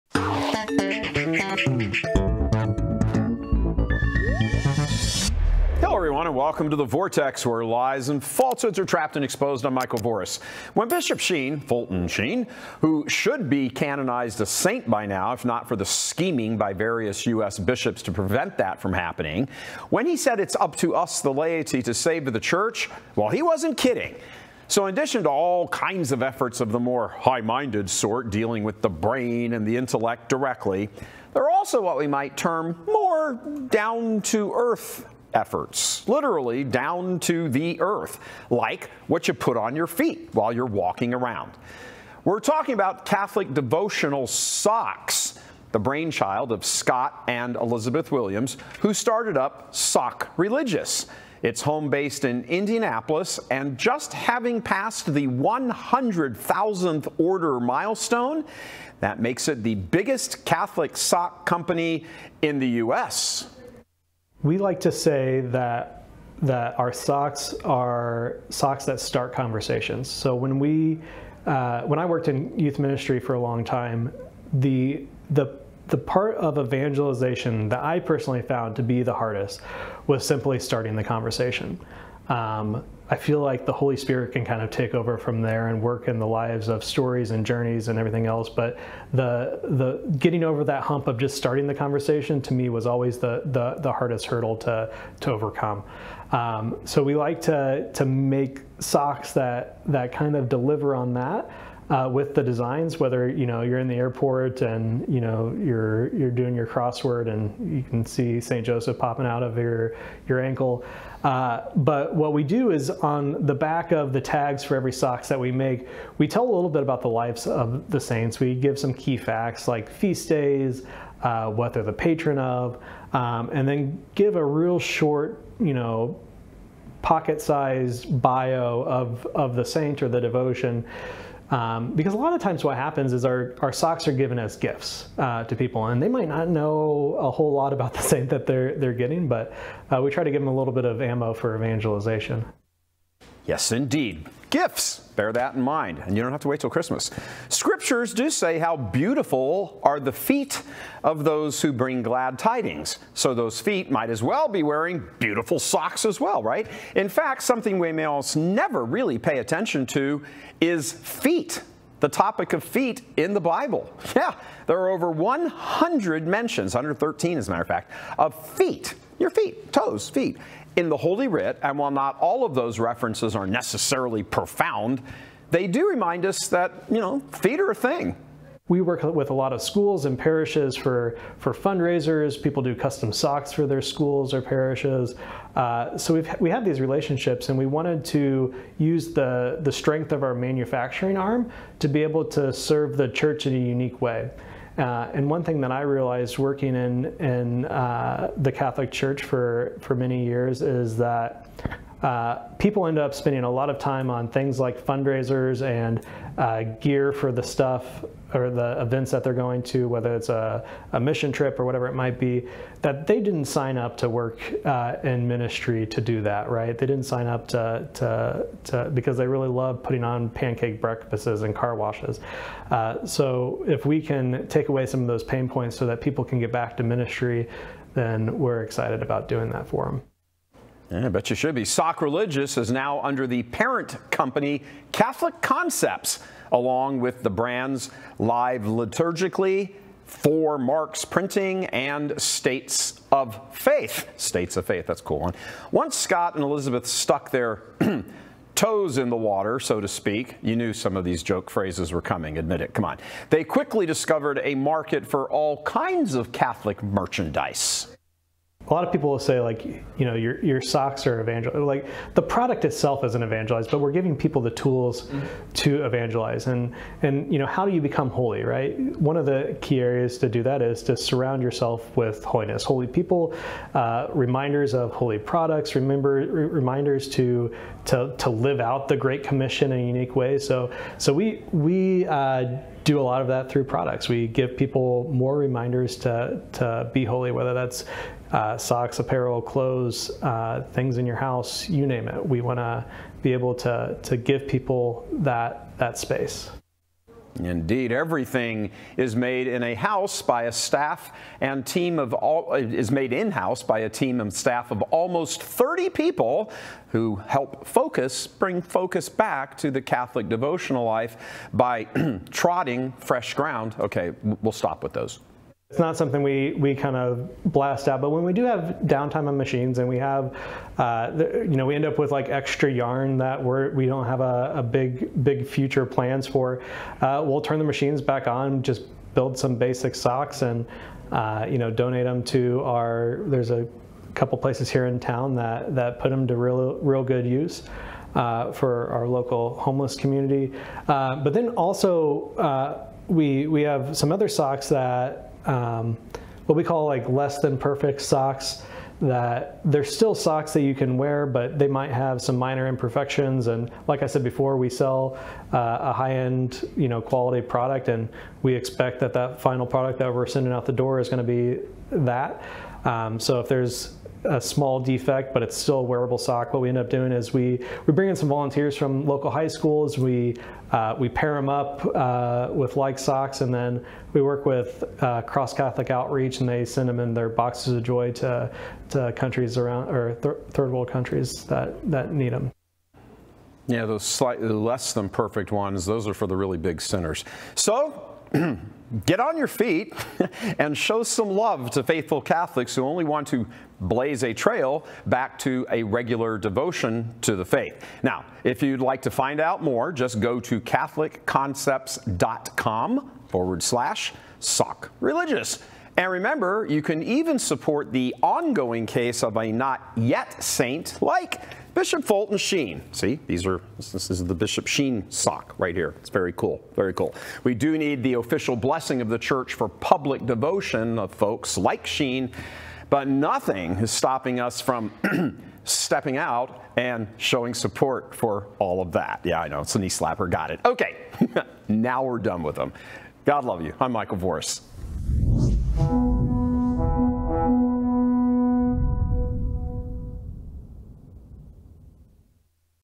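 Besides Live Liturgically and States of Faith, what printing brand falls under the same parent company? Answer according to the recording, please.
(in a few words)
Four Marks Printing.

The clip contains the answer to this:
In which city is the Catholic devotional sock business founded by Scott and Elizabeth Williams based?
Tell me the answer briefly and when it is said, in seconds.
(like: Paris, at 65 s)
Indianapolis, at 52 s.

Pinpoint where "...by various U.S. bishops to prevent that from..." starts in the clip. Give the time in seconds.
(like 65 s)
16 s.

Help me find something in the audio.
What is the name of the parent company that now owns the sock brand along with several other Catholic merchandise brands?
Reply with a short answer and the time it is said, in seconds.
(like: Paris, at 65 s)
Catholic Concepts, at 234 s.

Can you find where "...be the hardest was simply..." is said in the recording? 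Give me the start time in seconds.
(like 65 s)
78 s.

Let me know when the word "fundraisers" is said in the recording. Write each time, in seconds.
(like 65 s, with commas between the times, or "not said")
181 s, 204 s.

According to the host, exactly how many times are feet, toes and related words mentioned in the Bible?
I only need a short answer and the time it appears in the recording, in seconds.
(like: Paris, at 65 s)
113, at 166 s.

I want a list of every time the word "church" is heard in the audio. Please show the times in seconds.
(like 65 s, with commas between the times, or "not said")
22 s, 193 s, 198 s, 419 s.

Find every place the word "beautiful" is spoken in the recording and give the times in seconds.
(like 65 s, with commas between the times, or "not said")
148 s, 155 s.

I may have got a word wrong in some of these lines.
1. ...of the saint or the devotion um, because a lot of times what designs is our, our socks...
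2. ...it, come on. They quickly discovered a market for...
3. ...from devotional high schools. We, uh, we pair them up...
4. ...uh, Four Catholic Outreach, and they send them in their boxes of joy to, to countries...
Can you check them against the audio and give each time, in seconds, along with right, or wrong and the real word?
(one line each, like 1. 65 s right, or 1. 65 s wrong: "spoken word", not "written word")
1. 129 s wrong: "happens", not "designs"
2. 252 s right
3. 368 s wrong: "local", not "devotional"
4. 375 s wrong: "Cross", not "Four".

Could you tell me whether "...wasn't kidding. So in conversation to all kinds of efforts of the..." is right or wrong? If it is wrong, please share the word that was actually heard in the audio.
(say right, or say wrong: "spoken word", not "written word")
wrong: "addition", not "conversation".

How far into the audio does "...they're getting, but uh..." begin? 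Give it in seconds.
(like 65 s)
138 s.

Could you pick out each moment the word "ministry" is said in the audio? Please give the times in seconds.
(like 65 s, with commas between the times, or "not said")
72 s, 215 s, 226 s.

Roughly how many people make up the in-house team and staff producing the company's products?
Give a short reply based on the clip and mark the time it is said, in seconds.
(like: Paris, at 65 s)
almost 30, at 304 s.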